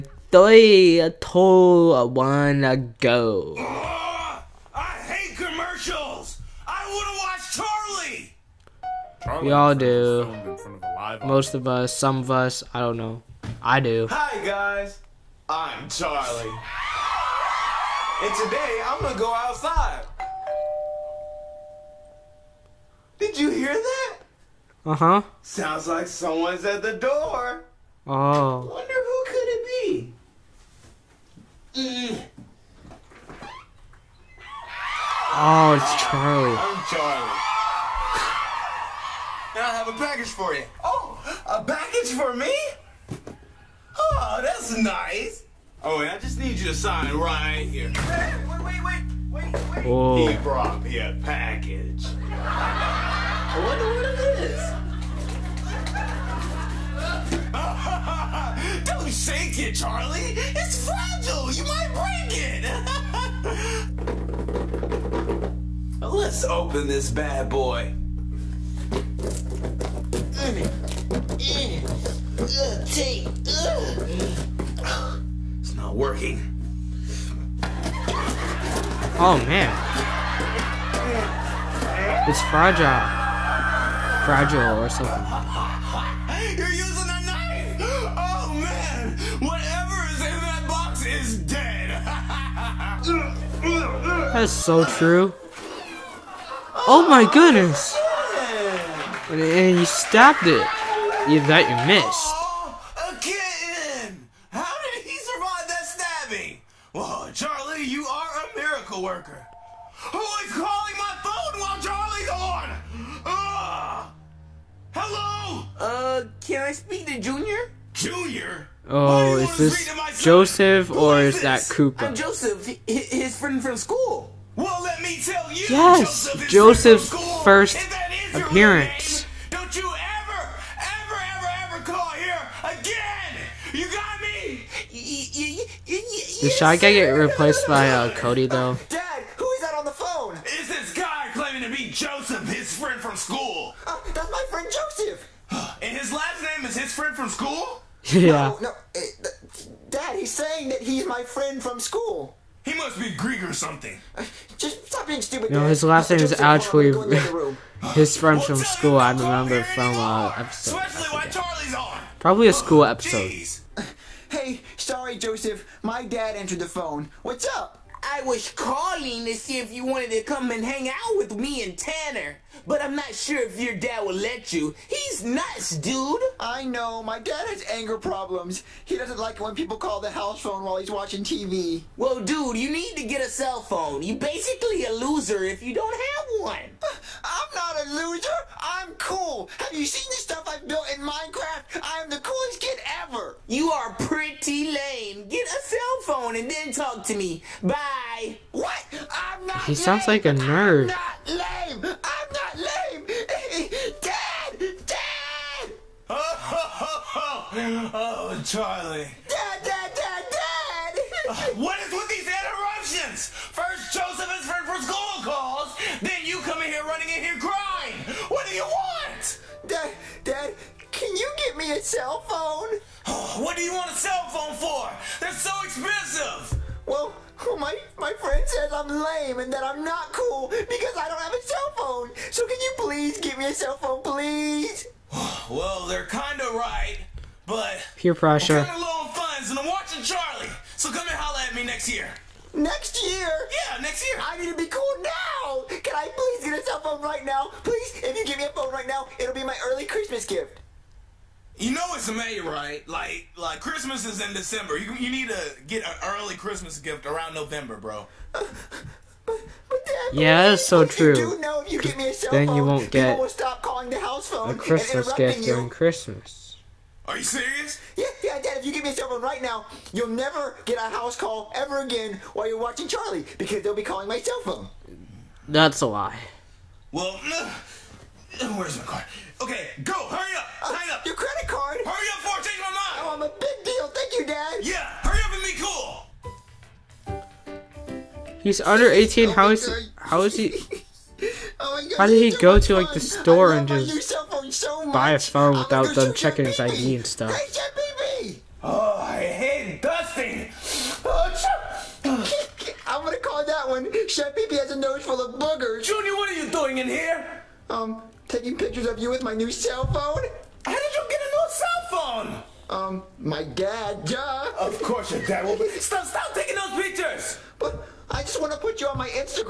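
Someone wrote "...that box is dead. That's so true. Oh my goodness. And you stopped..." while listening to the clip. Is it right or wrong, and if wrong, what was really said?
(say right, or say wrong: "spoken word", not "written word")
right.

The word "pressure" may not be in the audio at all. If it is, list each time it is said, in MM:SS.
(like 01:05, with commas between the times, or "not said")
03:58.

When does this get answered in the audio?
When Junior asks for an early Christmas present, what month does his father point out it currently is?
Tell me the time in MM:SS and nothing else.
04:12.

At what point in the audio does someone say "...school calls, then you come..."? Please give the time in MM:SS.
03:34.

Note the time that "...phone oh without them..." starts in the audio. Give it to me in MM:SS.
04:55.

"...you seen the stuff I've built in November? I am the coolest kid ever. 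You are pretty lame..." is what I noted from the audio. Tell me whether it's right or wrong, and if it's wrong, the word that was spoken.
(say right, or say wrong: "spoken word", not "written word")
wrong: "Minecraft", not "November".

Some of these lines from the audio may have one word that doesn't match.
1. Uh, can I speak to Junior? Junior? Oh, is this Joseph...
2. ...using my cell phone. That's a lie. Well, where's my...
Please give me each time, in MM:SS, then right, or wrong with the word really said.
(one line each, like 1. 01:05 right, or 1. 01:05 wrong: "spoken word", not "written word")
1. 01:55 right
2. 04:33 wrong: "calling", not "using".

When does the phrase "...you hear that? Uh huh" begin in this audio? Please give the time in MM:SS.
00:23.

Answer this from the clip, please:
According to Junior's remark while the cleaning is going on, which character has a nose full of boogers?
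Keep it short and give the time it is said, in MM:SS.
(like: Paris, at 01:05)
Chef P, at 05:04.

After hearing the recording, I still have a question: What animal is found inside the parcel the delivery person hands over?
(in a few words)
kitten.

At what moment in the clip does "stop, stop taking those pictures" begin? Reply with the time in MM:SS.
05:15.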